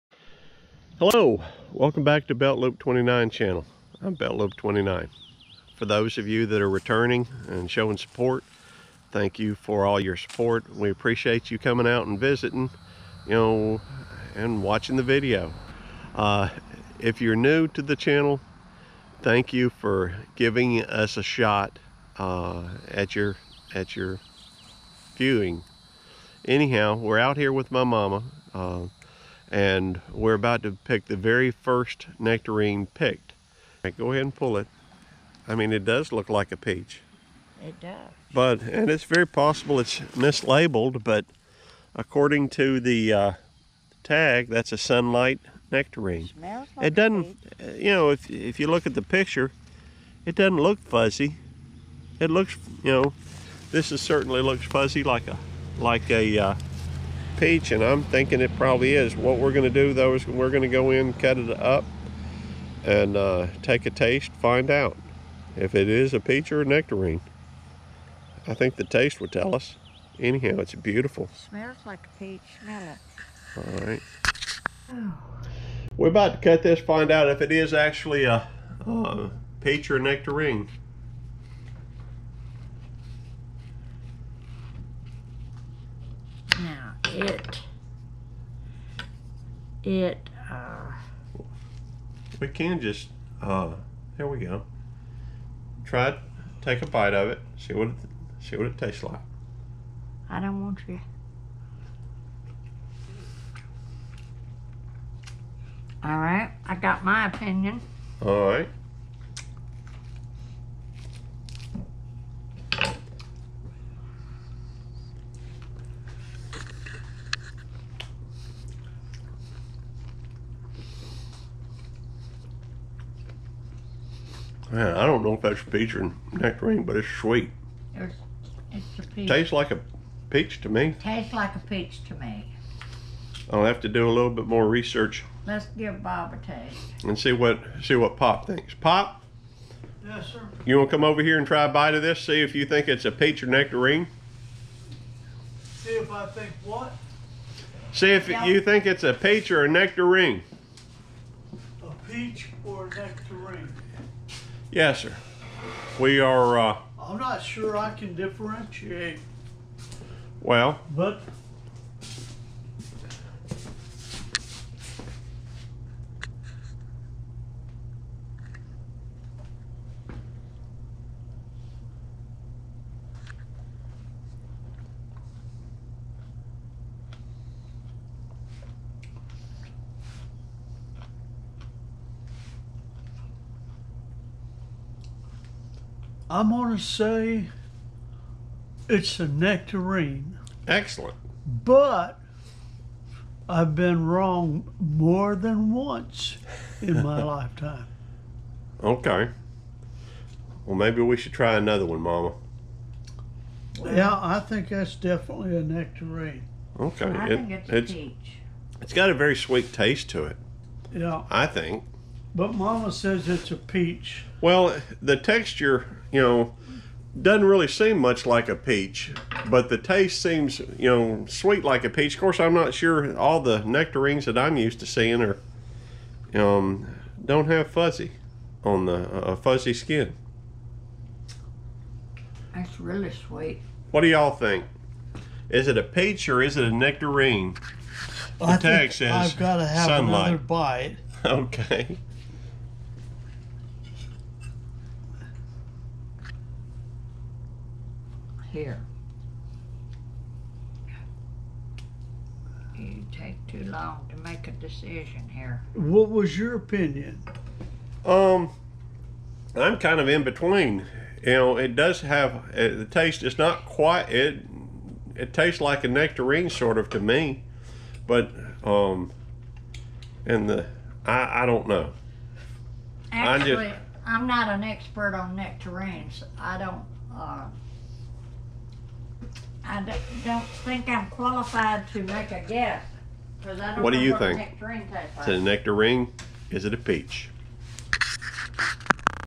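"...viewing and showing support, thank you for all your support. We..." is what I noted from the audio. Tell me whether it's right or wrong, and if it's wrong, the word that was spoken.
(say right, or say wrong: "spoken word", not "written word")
wrong: "returning", not "viewing".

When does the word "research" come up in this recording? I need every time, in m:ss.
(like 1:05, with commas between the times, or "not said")
2:14.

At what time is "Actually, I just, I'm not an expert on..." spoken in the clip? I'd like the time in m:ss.
4:33.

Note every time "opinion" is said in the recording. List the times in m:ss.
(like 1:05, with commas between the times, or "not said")
1:47, 4:16.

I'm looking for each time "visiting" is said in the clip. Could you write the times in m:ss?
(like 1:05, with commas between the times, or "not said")
0:12.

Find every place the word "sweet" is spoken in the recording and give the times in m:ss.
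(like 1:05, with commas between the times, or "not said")
2:07, 3:29, 3:41, 3:53.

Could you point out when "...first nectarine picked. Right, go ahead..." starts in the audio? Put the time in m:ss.
0:31.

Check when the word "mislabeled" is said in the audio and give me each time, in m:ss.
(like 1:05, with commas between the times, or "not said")
0:39.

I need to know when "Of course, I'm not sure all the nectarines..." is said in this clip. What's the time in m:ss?
3:42.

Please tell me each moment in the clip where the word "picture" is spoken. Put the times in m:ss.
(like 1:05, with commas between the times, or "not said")
0:49.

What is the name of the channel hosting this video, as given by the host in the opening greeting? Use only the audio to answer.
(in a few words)
Beltloop29.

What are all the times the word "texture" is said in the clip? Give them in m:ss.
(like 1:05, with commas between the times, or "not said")
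3:35.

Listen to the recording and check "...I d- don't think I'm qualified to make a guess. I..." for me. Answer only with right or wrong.
right.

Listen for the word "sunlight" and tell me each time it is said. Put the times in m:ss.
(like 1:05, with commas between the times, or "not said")
0:44, 3:59.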